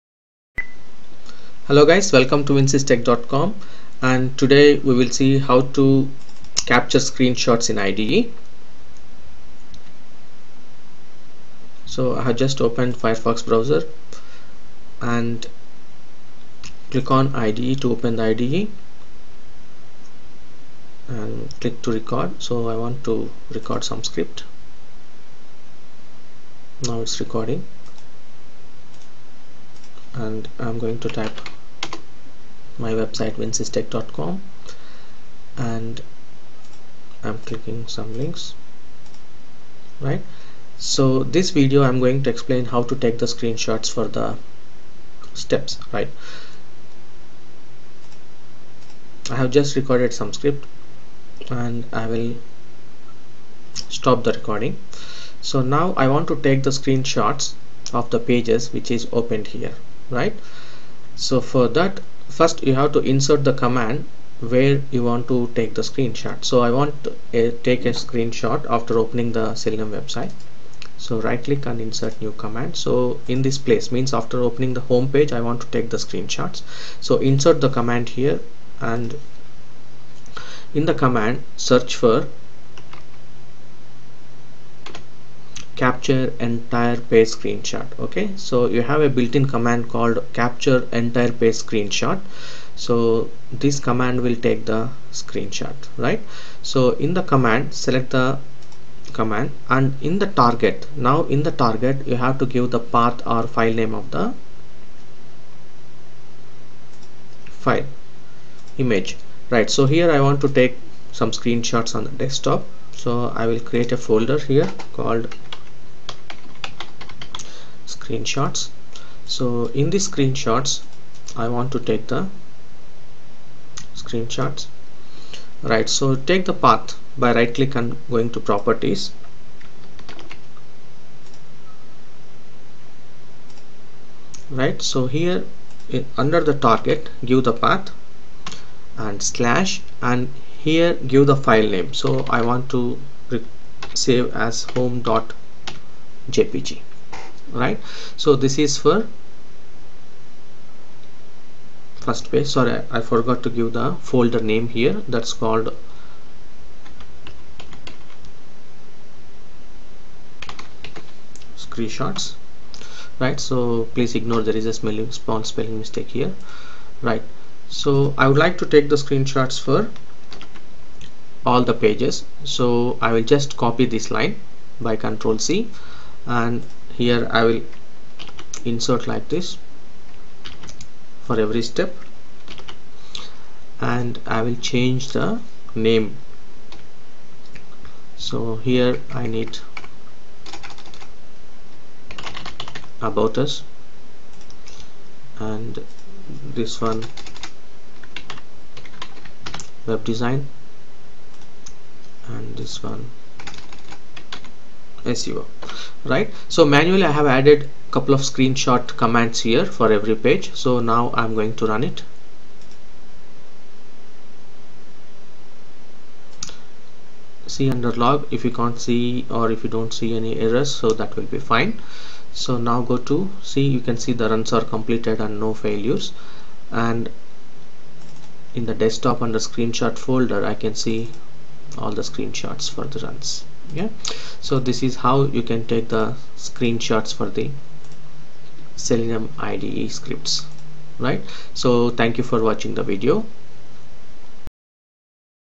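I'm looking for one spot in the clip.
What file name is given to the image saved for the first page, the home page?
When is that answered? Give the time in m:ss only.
2:24.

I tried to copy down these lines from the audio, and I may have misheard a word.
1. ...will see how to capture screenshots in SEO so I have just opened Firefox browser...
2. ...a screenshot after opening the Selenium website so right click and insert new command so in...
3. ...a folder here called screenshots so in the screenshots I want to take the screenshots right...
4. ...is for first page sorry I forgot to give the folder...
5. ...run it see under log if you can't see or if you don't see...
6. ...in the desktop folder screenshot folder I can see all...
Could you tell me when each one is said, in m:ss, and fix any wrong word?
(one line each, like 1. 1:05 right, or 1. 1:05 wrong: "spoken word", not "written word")
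1. 0:04 wrong: "IDE", not "SEO"
2. 1:07 right
3. 1:53 right
4. 2:28 right
5. 3:31 right
6. 3:48 wrong: "under", not "folder".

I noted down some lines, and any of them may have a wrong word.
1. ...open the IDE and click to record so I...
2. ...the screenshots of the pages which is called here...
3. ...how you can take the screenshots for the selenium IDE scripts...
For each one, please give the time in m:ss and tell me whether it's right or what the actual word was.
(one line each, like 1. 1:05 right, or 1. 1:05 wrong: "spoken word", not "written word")
1. 0:17 right
2. 0:56 wrong: "opened", not "called"
3. 3:54 right.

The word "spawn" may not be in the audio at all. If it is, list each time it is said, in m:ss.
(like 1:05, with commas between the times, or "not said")
2:45.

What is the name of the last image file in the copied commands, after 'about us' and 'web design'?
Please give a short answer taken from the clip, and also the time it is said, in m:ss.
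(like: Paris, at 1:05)
SEO, at 3:25.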